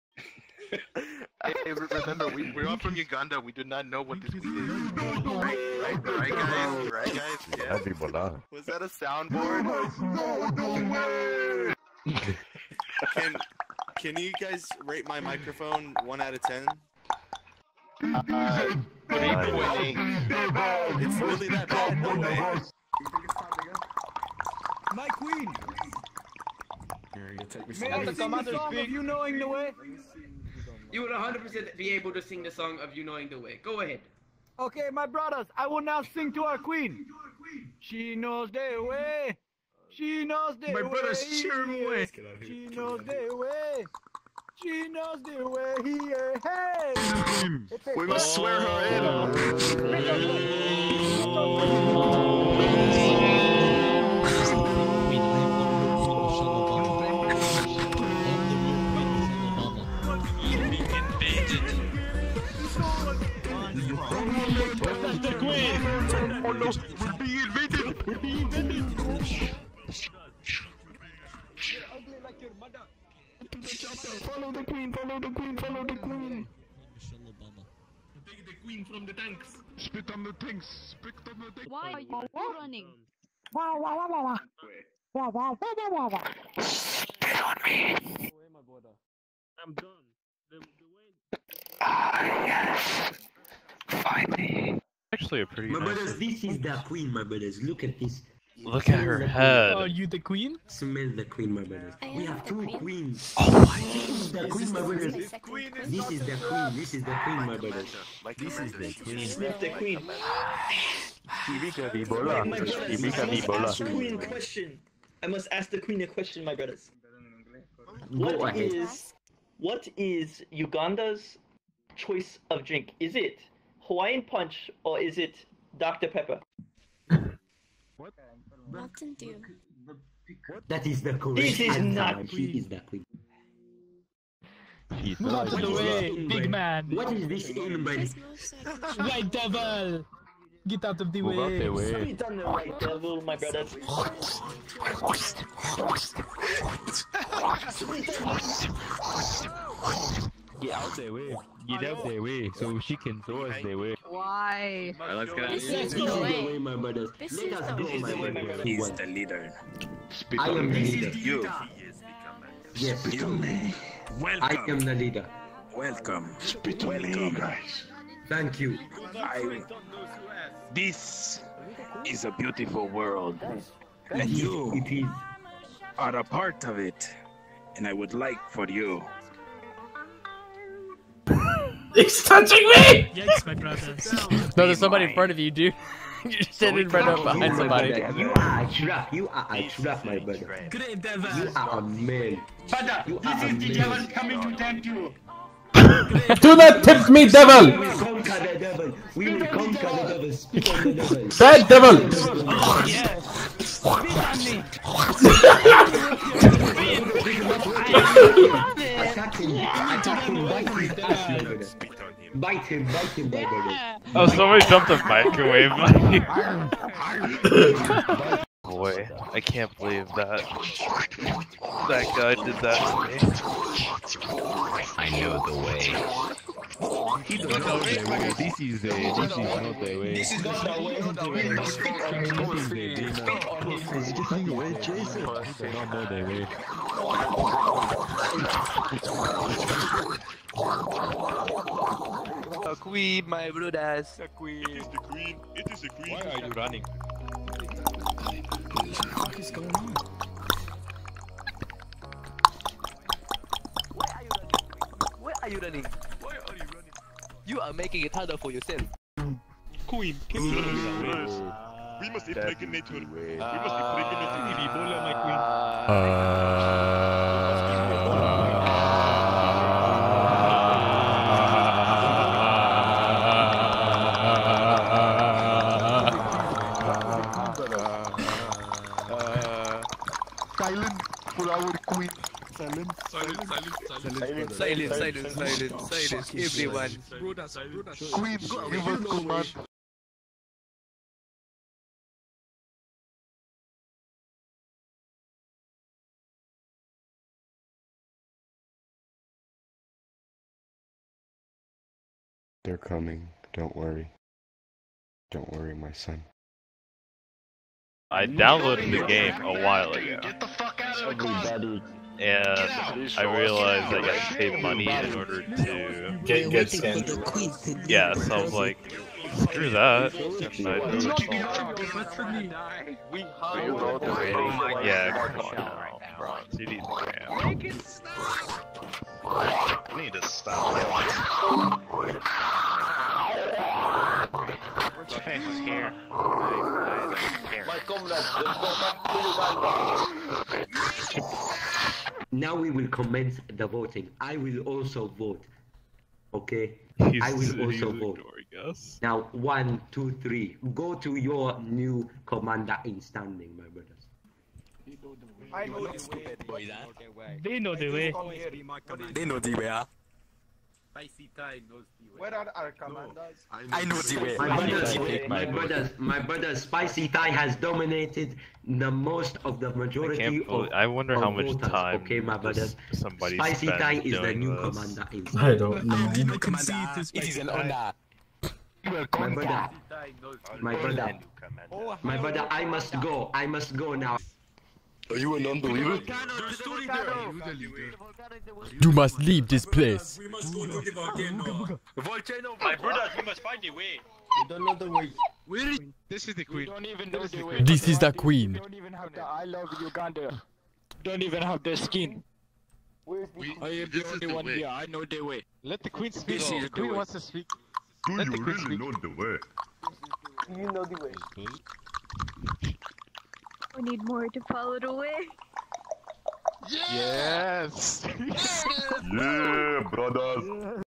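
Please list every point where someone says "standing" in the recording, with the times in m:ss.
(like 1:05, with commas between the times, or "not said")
3:06, 5:53.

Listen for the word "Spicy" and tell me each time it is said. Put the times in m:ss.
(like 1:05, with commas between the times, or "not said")
6:00, 6:06, 6:13.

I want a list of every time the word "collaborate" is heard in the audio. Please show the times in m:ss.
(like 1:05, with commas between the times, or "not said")
not said.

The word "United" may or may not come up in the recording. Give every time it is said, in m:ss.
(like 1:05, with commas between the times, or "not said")
not said.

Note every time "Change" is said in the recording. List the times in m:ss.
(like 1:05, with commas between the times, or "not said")
5:35.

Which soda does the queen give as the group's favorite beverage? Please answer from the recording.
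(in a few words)
Mountain Dew.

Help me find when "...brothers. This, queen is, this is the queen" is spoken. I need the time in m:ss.
1:44.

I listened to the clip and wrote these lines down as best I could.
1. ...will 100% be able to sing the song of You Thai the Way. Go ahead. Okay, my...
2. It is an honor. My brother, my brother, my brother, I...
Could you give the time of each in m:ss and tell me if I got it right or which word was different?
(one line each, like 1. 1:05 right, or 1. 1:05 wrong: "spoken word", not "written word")
1. 0:31 wrong: "Knowing", not "Thai"
2. 6:17 right.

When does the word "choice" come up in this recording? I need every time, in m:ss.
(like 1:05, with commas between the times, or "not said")
2:01.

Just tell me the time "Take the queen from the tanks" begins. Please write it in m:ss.
1:18.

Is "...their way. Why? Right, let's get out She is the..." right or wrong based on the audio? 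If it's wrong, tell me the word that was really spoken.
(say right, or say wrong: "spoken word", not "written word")
wrong: "This", not "She".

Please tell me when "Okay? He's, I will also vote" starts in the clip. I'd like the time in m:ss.
5:46.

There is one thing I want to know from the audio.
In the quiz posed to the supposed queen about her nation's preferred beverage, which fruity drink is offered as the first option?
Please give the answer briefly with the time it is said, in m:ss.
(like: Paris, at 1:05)
Hawaiian Punch, at 2:03.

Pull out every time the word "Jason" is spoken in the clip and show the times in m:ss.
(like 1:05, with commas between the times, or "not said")
3:54.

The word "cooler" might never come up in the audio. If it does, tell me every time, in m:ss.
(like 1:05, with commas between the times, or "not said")
not said.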